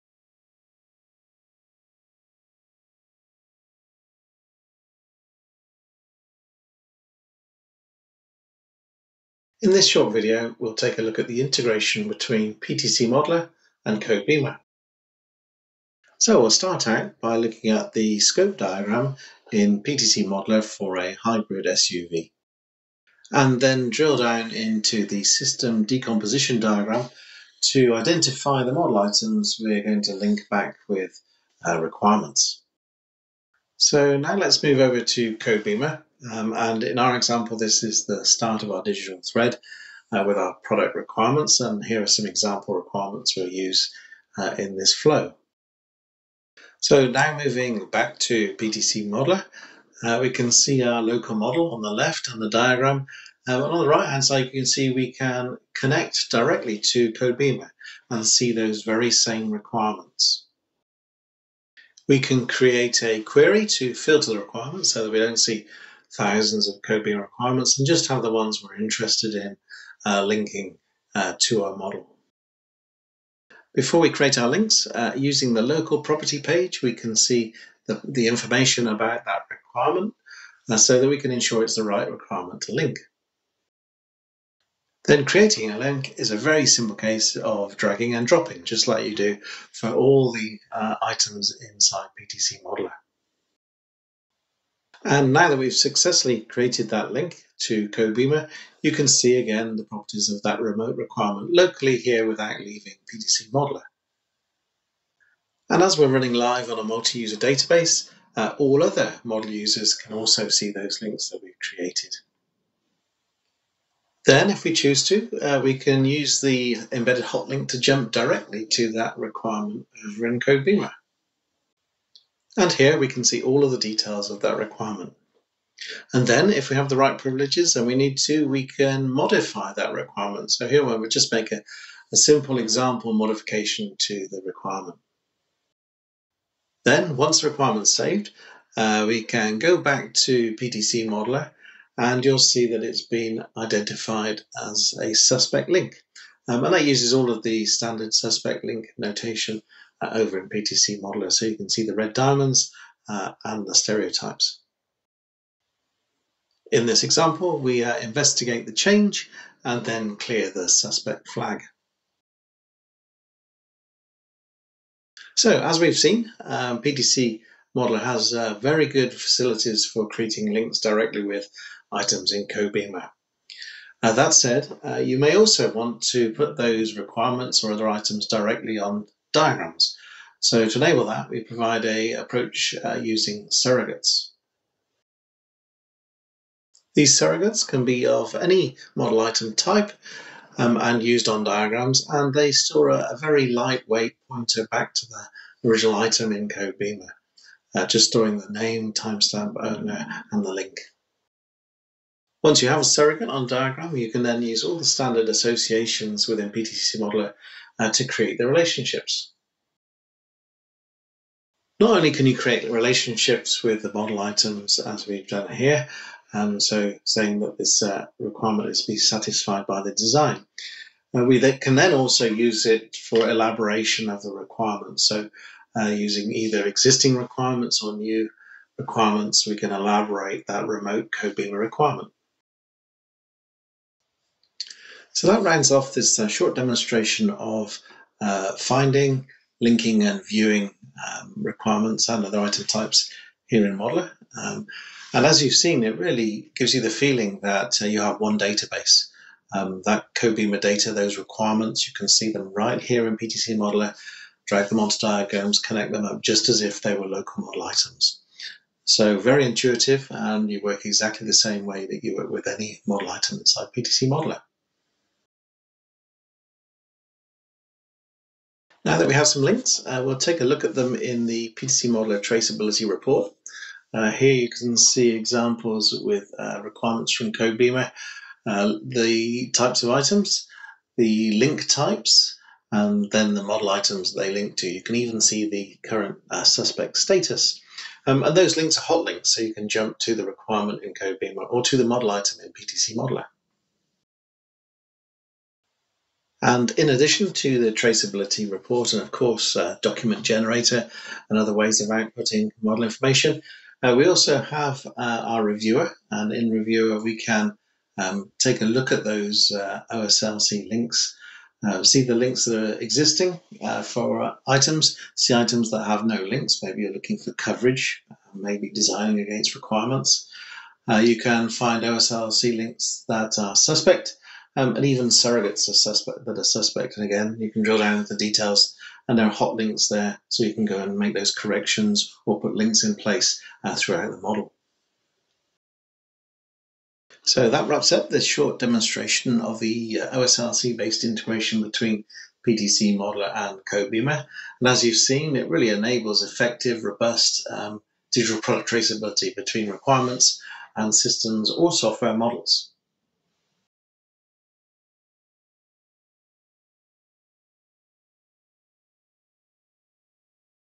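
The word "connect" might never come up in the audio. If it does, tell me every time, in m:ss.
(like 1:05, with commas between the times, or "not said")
0:55, 4:15.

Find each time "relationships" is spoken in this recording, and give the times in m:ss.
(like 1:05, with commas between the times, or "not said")
3:28, 3:32.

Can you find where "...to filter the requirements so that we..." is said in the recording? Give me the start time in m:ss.
1:03.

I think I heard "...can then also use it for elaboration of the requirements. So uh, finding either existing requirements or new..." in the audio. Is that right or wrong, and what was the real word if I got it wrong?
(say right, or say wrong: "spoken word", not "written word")
wrong: "using", not "finding".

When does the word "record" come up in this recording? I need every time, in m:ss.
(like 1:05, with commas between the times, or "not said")
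not said.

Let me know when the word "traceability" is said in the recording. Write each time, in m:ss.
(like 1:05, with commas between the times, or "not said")
4:32, 4:57, 5:48.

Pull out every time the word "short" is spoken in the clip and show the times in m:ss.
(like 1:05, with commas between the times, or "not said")
0:09, 3:56, 5:38.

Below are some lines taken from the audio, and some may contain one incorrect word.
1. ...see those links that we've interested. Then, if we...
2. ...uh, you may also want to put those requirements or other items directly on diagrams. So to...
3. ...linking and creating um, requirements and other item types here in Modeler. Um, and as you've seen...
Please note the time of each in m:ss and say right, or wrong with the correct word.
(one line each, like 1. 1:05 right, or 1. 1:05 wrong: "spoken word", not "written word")
1. 1:50 wrong: "created", not "interested"
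2. 2:54 right
3. 3:59 wrong: "viewing", not "creating".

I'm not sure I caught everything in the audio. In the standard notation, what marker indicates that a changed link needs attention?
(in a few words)
red diamonds.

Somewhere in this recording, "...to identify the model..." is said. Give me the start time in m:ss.
0:27.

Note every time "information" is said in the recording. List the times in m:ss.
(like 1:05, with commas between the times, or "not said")
1:18, 5:02.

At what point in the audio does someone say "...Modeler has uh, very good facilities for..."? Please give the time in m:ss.
2:47.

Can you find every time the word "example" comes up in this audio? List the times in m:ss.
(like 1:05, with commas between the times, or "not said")
0:37, 0:42, 2:12, 2:37, 4:35.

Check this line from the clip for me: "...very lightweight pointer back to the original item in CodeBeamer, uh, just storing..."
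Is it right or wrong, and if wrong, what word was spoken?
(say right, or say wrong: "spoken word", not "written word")
right.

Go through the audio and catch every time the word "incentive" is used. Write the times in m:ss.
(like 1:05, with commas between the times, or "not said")
not said.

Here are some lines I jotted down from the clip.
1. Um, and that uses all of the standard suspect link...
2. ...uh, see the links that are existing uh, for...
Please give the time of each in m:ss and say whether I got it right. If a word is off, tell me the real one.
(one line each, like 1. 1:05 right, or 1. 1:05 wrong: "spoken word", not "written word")
1. 2:26 right
2. 5:11 right.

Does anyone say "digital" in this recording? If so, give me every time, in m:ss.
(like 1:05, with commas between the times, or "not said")
0:38, 5:48.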